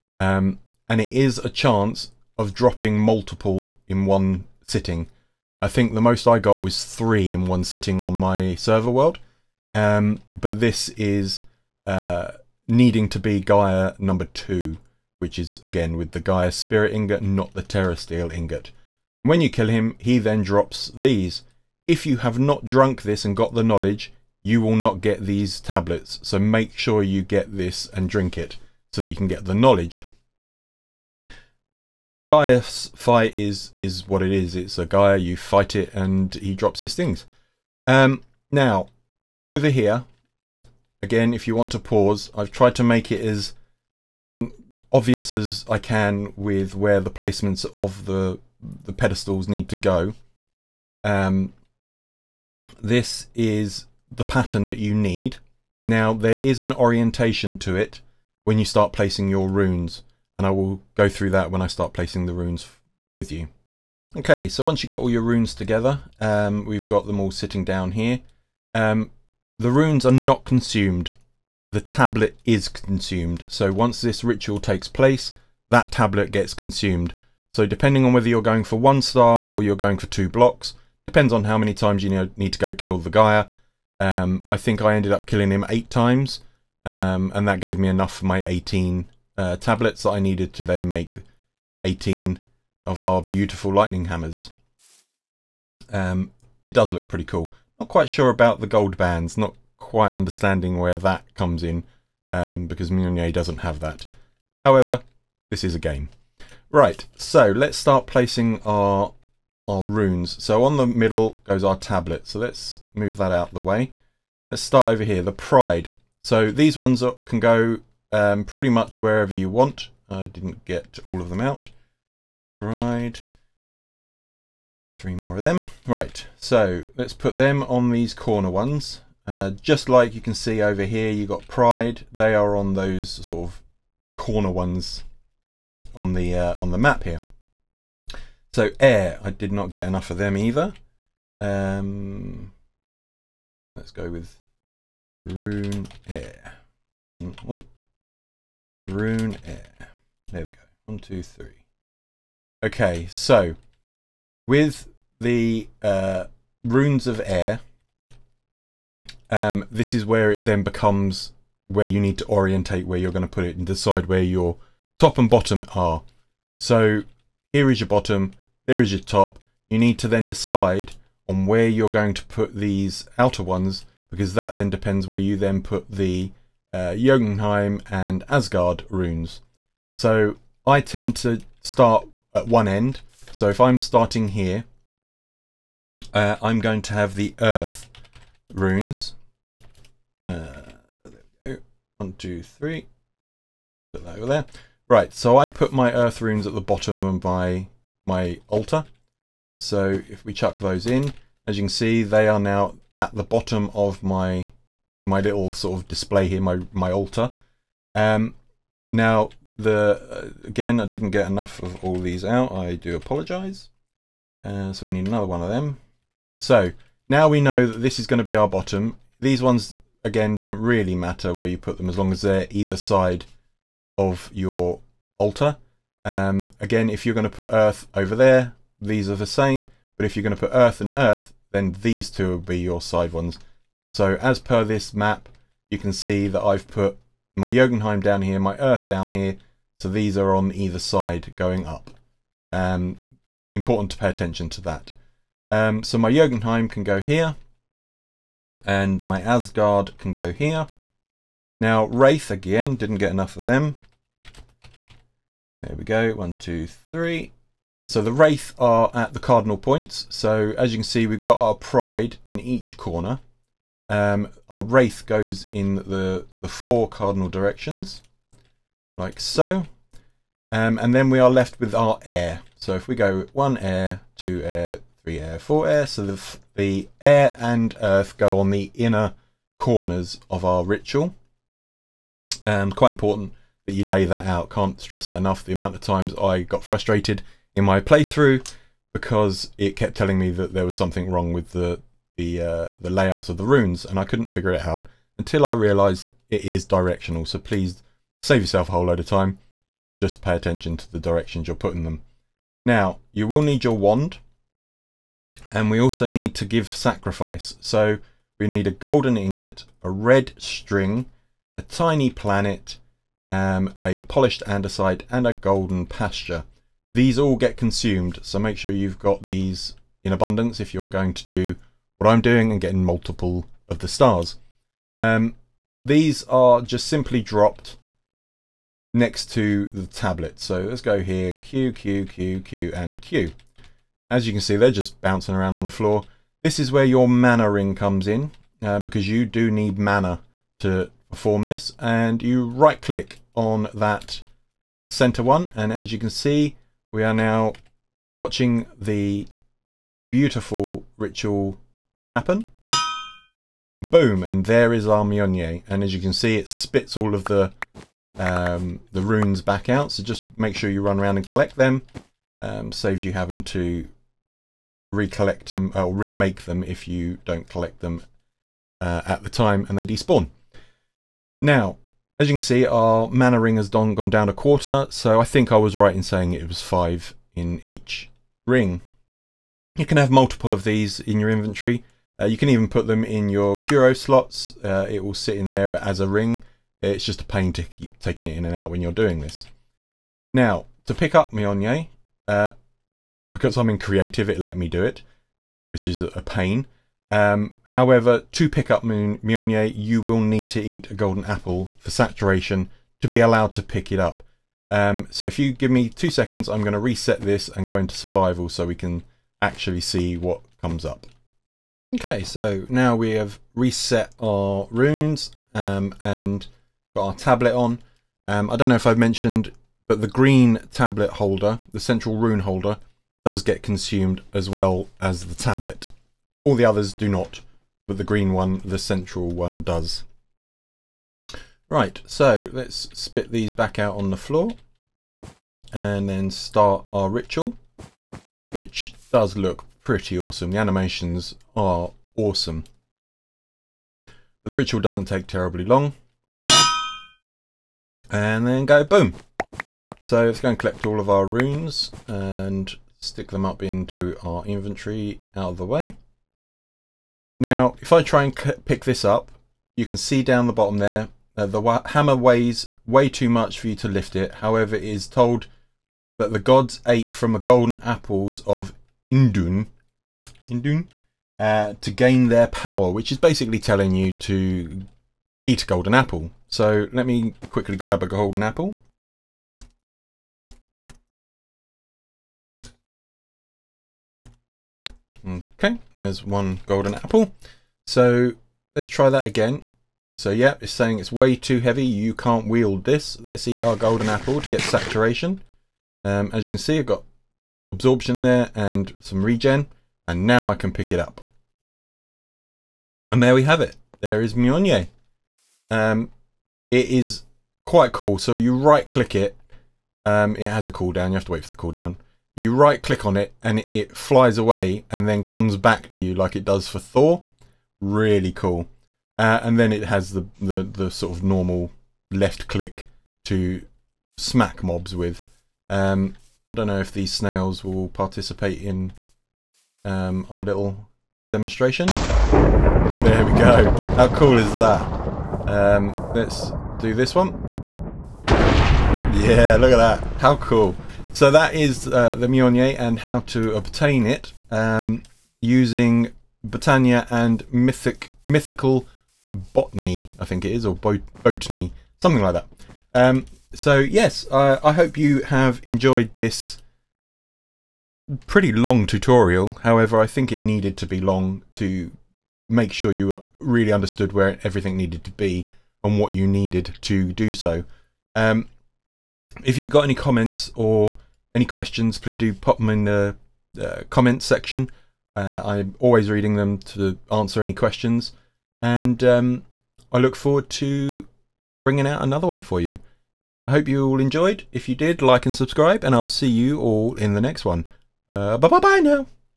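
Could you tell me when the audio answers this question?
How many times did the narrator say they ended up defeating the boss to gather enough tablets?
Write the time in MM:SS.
01:25.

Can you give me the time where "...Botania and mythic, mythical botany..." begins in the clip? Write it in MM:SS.
09:06.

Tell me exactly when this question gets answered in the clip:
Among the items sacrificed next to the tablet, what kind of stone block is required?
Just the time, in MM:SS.
05:14.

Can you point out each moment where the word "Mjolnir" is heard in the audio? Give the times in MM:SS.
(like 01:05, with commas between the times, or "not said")
01:42, 05:55, 06:31, 06:38, 08:24, 09:02.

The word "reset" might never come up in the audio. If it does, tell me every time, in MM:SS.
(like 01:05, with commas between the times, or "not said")
06:46, 06:53.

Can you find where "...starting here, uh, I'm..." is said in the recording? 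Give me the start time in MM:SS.
03:03.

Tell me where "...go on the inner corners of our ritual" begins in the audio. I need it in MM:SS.
04:38.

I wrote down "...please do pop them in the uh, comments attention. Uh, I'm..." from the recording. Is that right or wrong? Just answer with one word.
wrong.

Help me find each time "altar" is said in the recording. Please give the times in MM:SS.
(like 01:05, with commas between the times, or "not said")
03:18, 03:26, 03:45.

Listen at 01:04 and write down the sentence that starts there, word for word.
Okay, so once you've got all your runes together, um, we've got them all sitting down here.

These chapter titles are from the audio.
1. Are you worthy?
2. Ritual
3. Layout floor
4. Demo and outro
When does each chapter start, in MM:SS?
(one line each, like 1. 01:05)
1. 07:13
2. 05:38
3. 00:38
4. 08:48.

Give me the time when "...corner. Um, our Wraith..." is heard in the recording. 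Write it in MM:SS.
04:22.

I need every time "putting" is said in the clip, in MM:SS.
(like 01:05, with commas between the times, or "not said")
05:01.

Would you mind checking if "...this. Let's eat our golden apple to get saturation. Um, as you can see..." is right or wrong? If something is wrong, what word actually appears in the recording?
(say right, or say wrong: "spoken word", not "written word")
right.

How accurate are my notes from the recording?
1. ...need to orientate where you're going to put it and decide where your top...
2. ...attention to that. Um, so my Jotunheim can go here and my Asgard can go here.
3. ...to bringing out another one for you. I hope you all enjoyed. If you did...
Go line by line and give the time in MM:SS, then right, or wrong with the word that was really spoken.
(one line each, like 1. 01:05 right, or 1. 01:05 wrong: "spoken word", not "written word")
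1. 02:41 right
2. 04:04 right
3. 09:40 right.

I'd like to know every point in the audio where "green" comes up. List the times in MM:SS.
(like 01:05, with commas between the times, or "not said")
07:00, 07:08.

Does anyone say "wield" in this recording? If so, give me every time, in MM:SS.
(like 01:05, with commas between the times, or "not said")
08:12.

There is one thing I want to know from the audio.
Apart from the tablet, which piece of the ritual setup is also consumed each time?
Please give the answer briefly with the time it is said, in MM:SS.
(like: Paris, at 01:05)
central rune holder, at 07:01.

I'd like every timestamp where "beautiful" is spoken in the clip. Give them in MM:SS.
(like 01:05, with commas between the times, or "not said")
01:33, 05:50.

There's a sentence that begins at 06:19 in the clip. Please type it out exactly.
You can have multiple of these in your inventory.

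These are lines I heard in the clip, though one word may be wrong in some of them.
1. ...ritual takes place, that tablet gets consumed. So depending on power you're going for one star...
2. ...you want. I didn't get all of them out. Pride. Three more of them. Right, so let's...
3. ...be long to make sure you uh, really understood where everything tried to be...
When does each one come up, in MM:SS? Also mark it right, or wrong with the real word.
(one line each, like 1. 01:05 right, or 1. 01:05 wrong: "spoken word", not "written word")
1. 01:14 wrong: "whether", not "power"
2. 01:59 right
3. 09:20 wrong: "needed", not "tried".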